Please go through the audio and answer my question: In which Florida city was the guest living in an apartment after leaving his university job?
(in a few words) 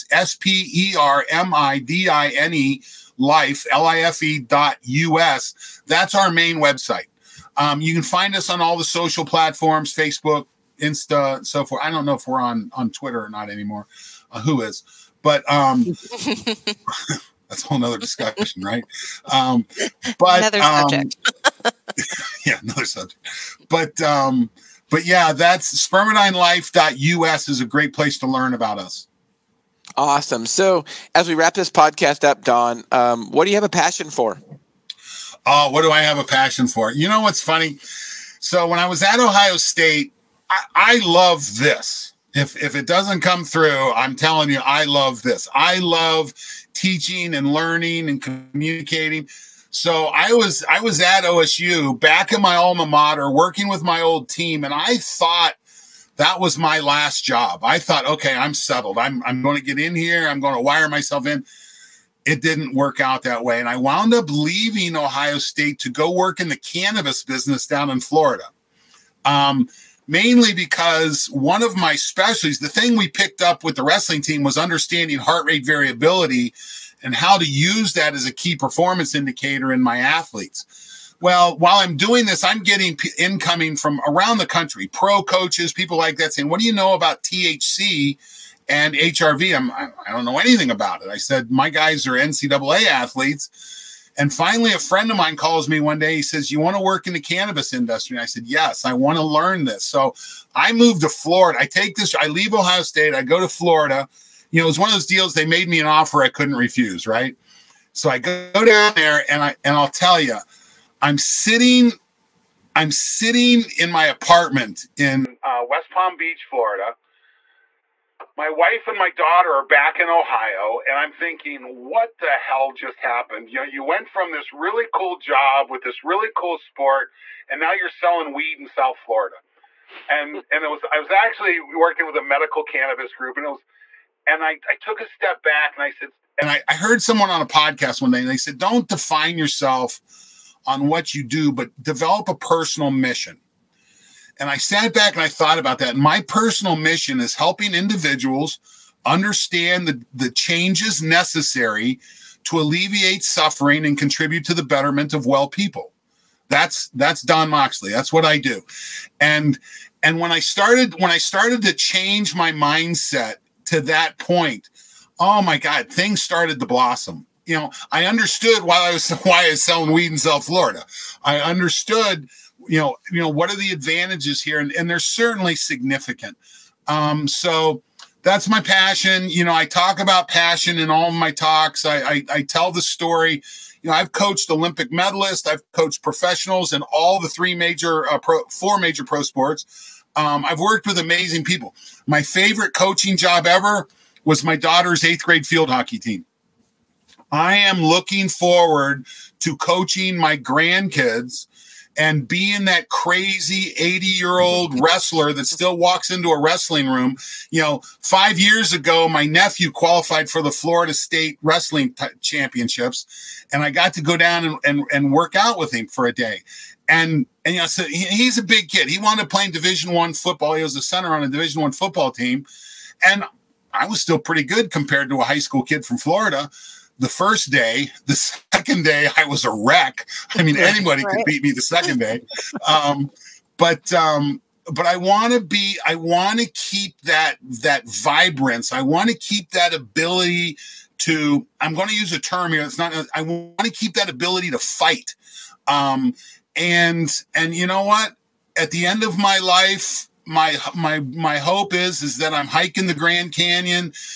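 West Palm Beach.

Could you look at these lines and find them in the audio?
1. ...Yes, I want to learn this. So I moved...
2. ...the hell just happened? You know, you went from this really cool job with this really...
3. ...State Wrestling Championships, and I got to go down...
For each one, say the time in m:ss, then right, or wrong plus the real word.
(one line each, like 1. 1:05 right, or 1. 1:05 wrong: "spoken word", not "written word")
1. 1:38 right
2. 2:02 right
3. 3:30 right.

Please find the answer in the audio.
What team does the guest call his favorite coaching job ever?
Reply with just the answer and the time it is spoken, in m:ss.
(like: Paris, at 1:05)
daughter's eighth grade field hockey team, at 3:14.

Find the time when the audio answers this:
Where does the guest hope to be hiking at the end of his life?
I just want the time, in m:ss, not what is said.
4:12.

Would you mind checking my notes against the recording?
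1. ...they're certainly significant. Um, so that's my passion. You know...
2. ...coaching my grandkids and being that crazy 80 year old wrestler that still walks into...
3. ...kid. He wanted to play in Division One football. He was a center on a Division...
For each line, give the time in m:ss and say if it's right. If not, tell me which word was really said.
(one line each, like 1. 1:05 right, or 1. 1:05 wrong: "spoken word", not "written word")
1. 2:54 right
2. 3:19 right
3. 3:38 right.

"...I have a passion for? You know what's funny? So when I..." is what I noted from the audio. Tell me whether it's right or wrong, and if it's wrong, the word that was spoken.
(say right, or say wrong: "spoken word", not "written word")
right.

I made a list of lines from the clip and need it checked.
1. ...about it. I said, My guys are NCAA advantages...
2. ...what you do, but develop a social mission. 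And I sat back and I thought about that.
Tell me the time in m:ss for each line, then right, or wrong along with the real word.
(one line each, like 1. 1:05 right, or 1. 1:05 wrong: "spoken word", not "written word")
1. 1:30 wrong: "athletes", not "advantages"
2. 2:20 wrong: "personal", not "social".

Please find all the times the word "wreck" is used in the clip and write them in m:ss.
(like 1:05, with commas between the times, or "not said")
3:49.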